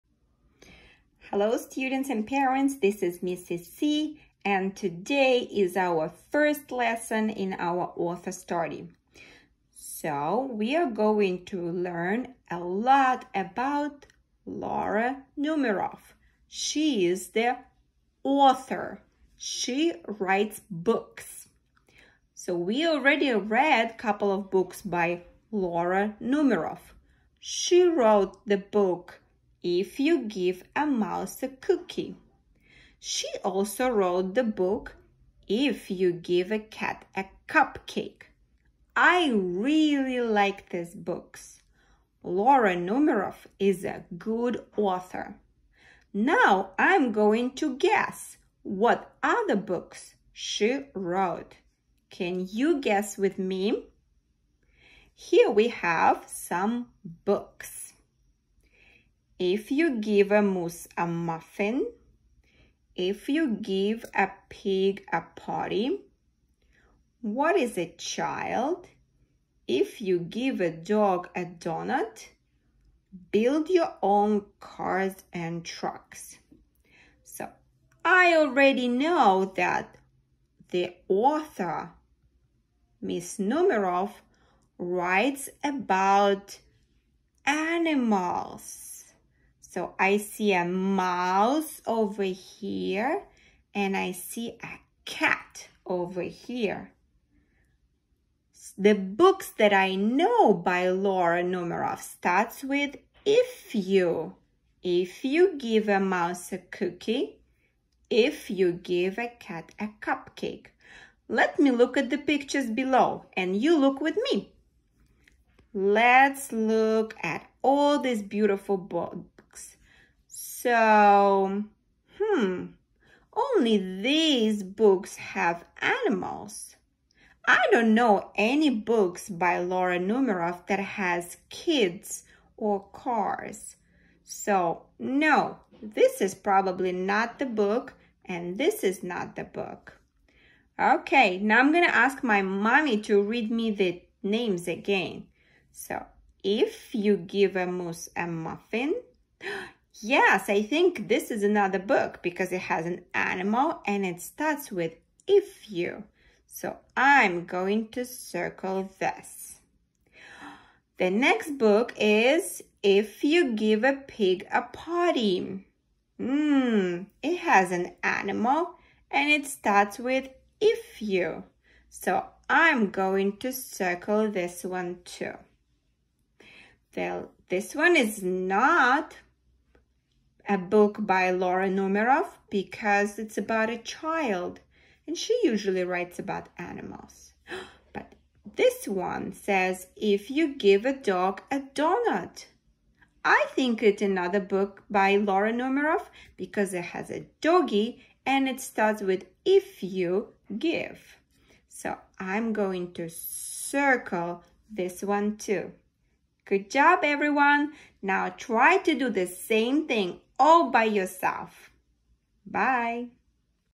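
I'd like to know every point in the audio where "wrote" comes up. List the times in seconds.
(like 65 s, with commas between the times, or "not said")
27 s, 33 s, 50 s.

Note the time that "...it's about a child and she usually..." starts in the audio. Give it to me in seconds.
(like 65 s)
183 s.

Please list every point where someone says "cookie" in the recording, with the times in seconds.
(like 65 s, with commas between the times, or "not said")
31 s, 106 s.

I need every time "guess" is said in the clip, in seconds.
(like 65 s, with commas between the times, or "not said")
47 s, 52 s.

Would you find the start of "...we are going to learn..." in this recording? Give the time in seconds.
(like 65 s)
10 s.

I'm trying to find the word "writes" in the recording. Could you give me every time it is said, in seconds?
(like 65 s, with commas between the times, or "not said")
20 s, 84 s, 185 s.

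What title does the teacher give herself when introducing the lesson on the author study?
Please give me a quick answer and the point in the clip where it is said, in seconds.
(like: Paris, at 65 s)
Mrs. C, at 3 s.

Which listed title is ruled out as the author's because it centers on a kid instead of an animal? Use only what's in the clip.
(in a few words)
What is a Child?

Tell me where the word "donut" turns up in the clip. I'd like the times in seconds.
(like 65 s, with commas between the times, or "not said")
71 s, 191 s.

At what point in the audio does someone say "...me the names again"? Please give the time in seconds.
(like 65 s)
143 s.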